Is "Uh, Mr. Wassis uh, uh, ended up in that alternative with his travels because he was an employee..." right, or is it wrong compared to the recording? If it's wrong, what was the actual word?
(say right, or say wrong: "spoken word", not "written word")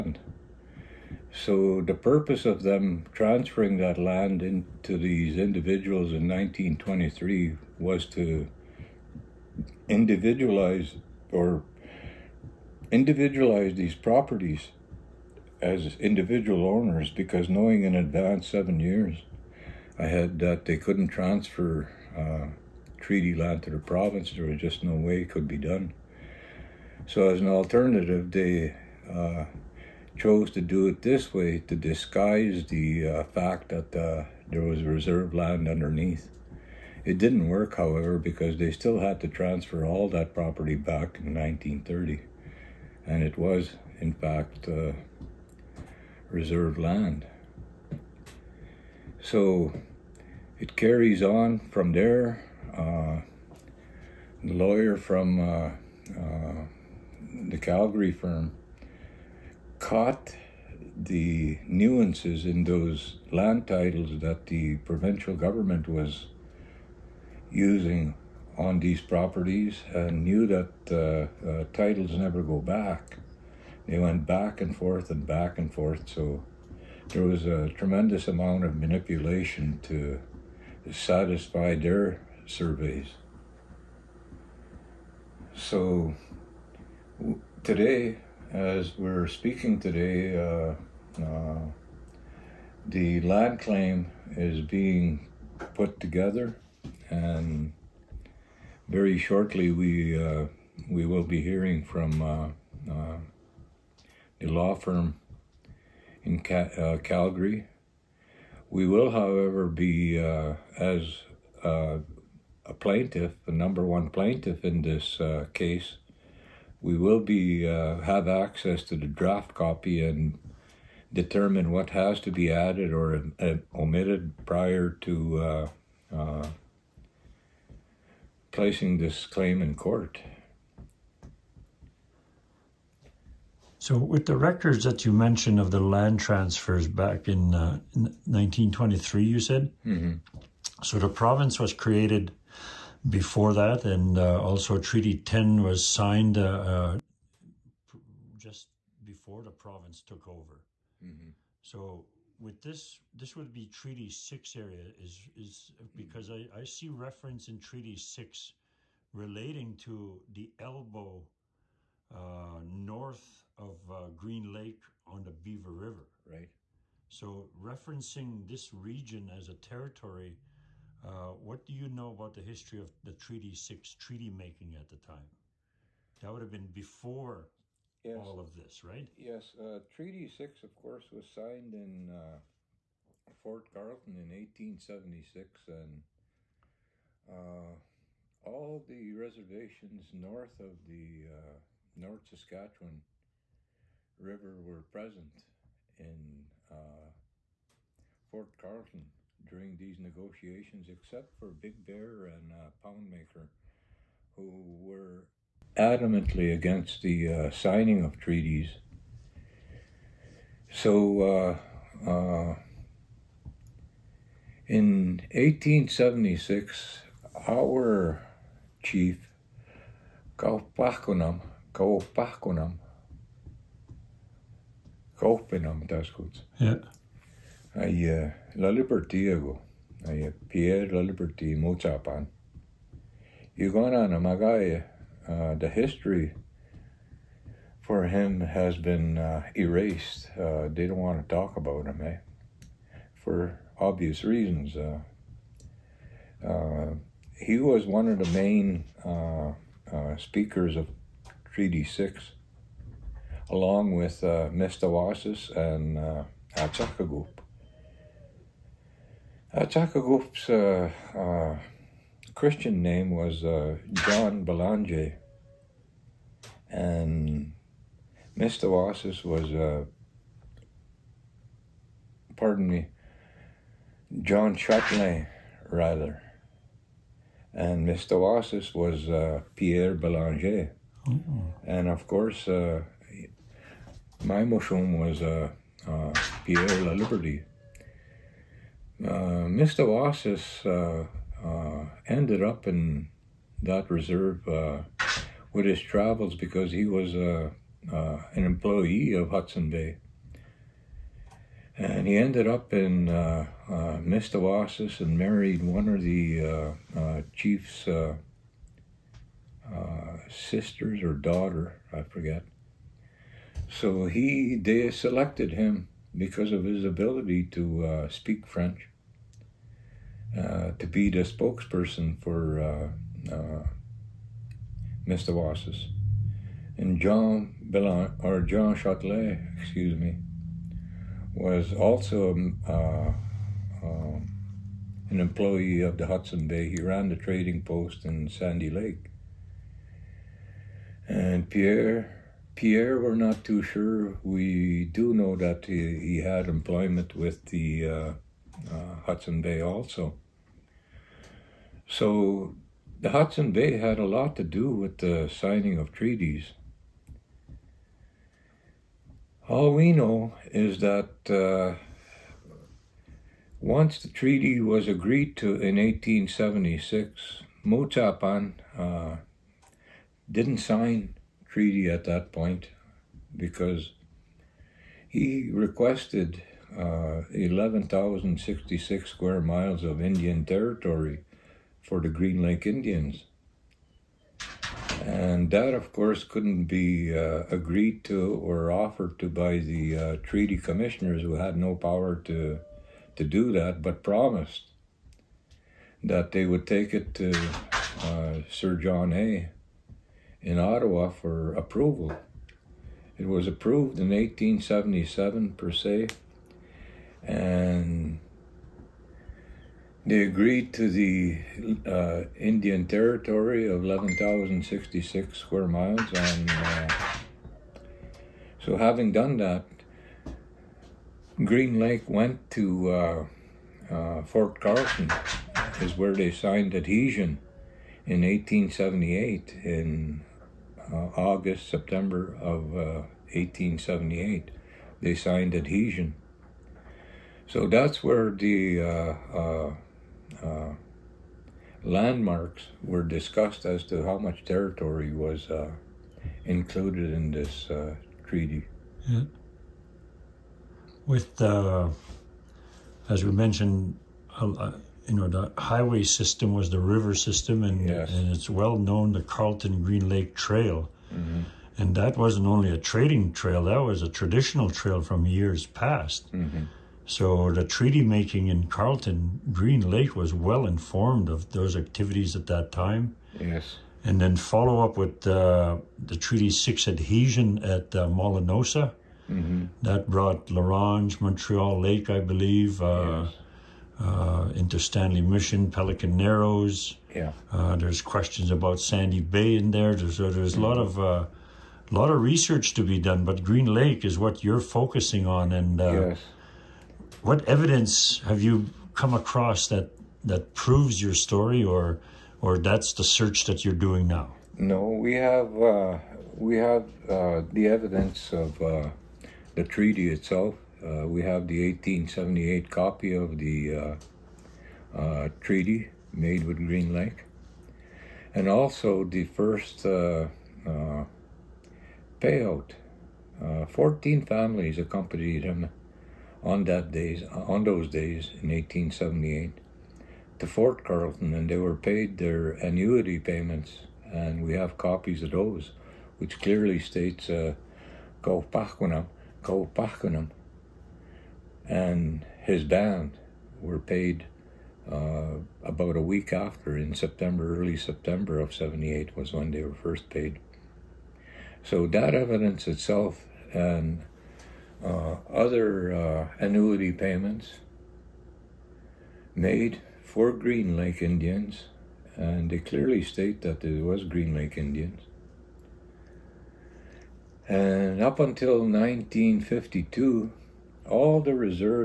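wrong: "reserve", not "alternative".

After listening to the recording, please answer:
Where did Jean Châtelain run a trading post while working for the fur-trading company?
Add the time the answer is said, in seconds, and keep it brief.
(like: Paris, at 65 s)
Sandy Lake, at 338 s.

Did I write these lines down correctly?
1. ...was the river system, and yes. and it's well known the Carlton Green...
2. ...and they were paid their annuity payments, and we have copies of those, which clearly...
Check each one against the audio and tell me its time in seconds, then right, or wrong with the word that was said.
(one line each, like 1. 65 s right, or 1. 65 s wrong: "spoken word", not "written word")
1. 456 s right
2. 531 s right.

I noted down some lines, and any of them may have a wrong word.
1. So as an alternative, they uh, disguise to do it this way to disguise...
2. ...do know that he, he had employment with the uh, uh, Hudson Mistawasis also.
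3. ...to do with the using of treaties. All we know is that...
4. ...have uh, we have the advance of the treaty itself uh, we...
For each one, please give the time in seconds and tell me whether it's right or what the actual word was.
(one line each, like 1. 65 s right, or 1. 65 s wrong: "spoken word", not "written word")
1. 27 s wrong: "chose", not "disguise"
2. 344 s wrong: "Bay", not "Mistawasis"
3. 354 s wrong: "signing", not "using"
4. 505 s wrong: "evidence", not "advance".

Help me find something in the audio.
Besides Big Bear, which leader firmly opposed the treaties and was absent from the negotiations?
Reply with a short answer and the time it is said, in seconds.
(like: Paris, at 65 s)
Poundmaker, at 202 s.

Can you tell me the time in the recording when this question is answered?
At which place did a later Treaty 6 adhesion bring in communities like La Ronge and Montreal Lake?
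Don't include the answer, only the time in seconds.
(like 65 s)
478 s.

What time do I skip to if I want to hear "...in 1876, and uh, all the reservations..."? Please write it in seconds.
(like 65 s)
184 s.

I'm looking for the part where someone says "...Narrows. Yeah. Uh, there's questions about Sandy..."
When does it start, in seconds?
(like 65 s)
486 s.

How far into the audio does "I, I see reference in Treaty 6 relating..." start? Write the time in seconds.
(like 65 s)
156 s.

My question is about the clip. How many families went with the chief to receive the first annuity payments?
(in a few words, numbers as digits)
14.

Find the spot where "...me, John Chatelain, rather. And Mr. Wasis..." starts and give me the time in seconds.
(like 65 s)
272 s.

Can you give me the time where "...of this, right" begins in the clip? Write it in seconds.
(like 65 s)
178 s.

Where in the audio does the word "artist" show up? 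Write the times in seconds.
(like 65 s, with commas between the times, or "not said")
not said.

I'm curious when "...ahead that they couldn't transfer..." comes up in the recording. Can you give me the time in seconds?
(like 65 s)
19 s.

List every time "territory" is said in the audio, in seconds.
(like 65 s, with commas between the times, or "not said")
169 s, 380 s, 412 s, 444 s.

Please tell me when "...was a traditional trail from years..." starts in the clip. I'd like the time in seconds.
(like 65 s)
463 s.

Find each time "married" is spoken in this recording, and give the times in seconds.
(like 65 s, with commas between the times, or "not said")
305 s.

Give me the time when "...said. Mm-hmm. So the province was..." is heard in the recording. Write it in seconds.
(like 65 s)
139 s.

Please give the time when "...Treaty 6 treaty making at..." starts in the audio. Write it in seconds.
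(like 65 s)
173 s.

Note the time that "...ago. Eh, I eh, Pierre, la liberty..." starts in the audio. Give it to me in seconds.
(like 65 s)
229 s.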